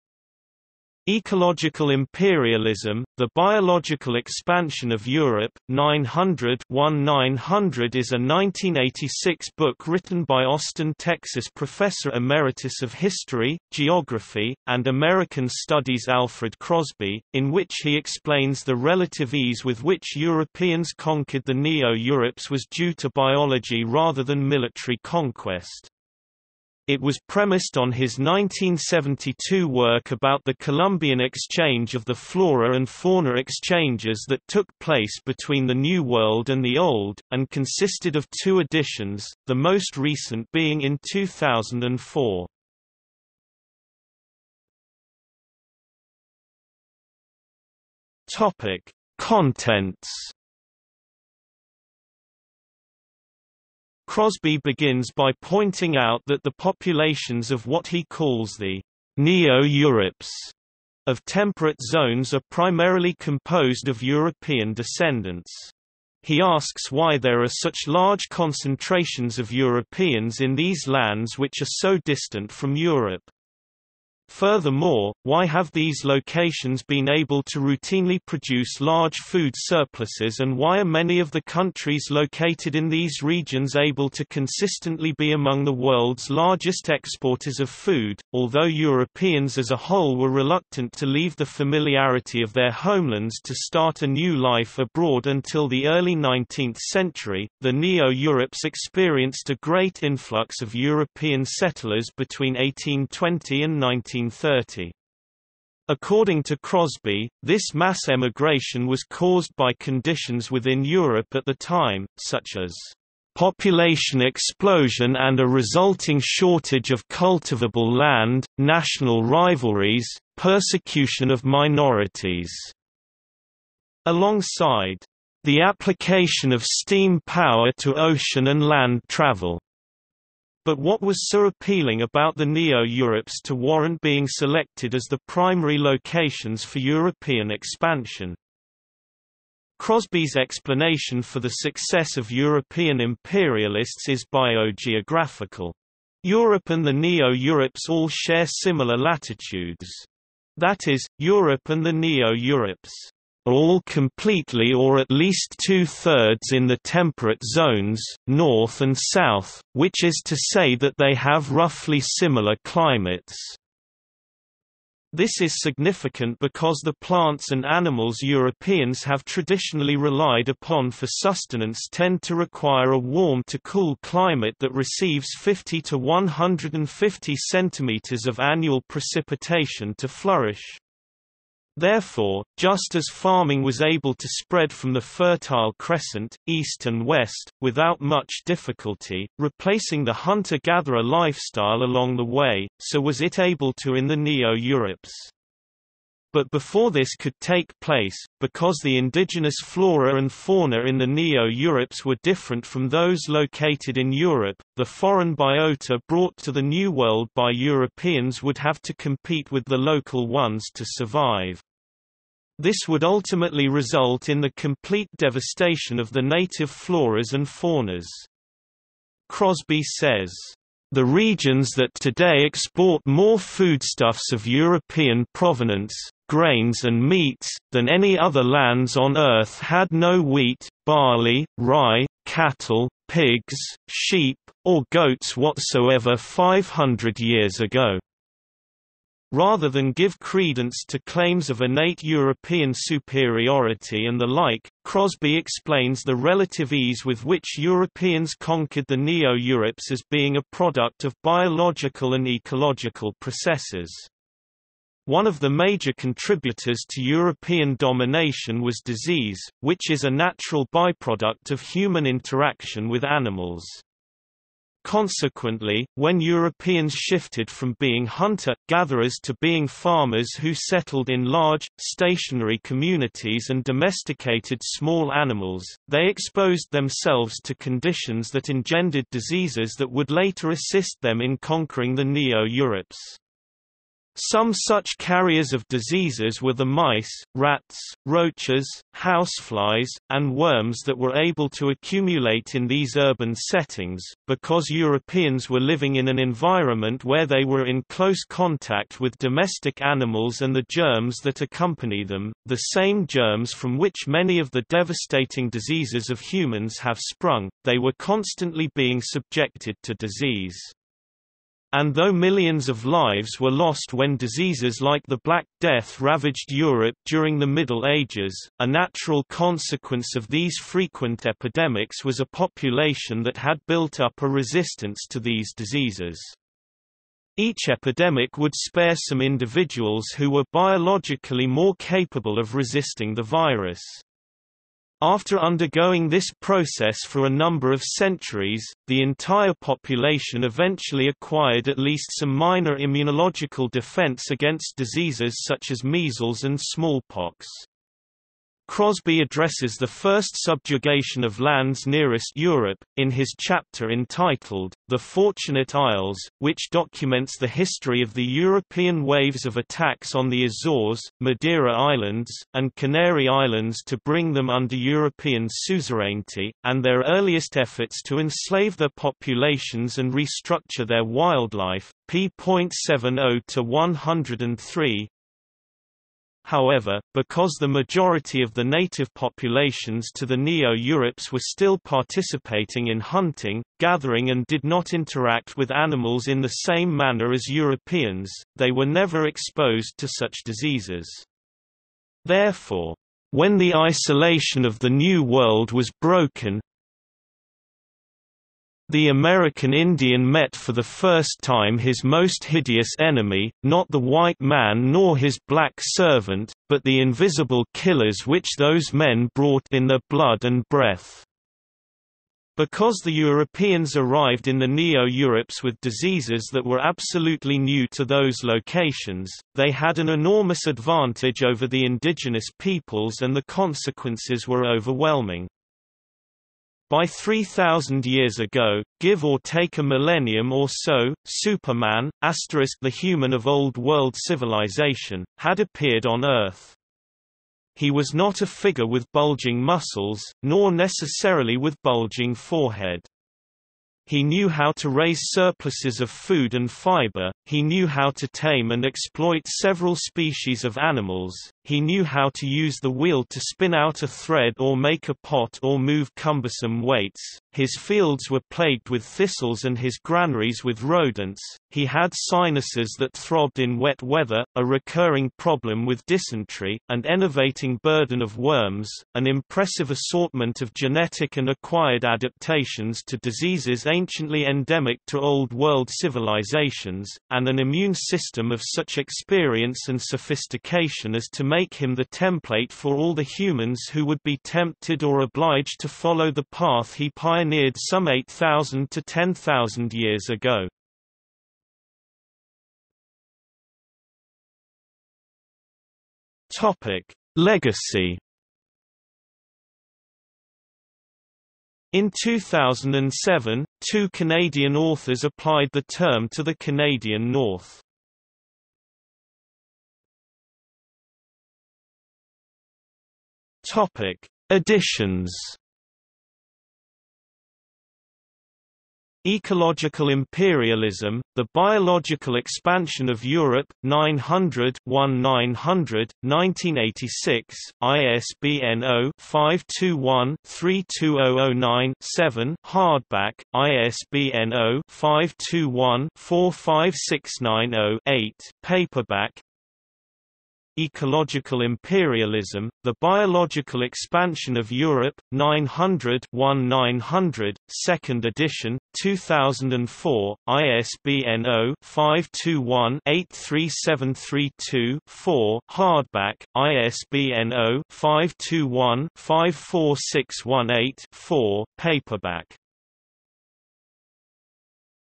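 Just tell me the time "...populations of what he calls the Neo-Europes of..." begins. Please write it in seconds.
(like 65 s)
56 s.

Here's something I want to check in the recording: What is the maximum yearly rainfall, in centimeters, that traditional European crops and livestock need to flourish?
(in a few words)
150 centimeters.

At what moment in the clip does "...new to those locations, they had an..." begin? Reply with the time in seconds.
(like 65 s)
417 s.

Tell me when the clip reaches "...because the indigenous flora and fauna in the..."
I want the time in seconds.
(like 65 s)
198 s.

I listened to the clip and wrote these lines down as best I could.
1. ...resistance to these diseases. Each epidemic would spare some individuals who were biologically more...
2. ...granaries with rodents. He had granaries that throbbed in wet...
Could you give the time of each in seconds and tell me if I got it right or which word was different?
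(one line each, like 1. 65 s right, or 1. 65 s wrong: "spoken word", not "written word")
1. 324 s right
2. 460 s wrong: "sinuses", not "granaries".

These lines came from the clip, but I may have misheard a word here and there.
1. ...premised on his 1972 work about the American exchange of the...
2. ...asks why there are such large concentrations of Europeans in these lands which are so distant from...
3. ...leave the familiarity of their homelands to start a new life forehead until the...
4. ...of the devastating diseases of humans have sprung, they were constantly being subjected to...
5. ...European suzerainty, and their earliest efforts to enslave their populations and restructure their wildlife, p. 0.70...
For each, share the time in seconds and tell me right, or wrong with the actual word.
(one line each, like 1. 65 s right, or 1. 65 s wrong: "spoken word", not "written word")
1. 27 s wrong: "Columbian", not "American"
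2. 66 s right
3. 91 s wrong: "abroad", not "forehead"
4. 304 s right
5. 364 s right.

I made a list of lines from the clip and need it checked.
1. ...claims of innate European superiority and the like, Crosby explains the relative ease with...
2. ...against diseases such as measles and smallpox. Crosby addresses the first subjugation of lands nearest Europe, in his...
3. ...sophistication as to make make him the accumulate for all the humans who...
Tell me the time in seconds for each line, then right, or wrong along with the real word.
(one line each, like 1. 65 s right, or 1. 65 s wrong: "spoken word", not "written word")
1. 241 s right
2. 344 s right
3. 480 s wrong: "template", not "accumulate".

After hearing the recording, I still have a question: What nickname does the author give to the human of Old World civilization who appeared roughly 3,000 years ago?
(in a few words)
Superman.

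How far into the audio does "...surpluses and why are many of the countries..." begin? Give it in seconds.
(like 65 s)
79 s.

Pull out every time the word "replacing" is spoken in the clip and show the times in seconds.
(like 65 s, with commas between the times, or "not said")
189 s.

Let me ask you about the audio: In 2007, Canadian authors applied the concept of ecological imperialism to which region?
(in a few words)
the Canadian North.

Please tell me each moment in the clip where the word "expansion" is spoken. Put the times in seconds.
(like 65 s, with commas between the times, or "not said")
4 s, 137 s, 522 s, 543 s.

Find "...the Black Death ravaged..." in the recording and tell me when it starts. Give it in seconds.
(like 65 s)
315 s.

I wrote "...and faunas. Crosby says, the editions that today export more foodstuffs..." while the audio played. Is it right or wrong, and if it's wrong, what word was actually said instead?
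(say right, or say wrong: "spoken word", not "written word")
wrong: "regions", not "editions".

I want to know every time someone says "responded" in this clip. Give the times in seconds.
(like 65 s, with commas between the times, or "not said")
not said.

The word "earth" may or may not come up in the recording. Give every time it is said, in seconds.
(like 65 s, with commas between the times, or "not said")
229 s, 436 s.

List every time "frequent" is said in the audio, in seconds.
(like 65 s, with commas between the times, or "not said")
320 s.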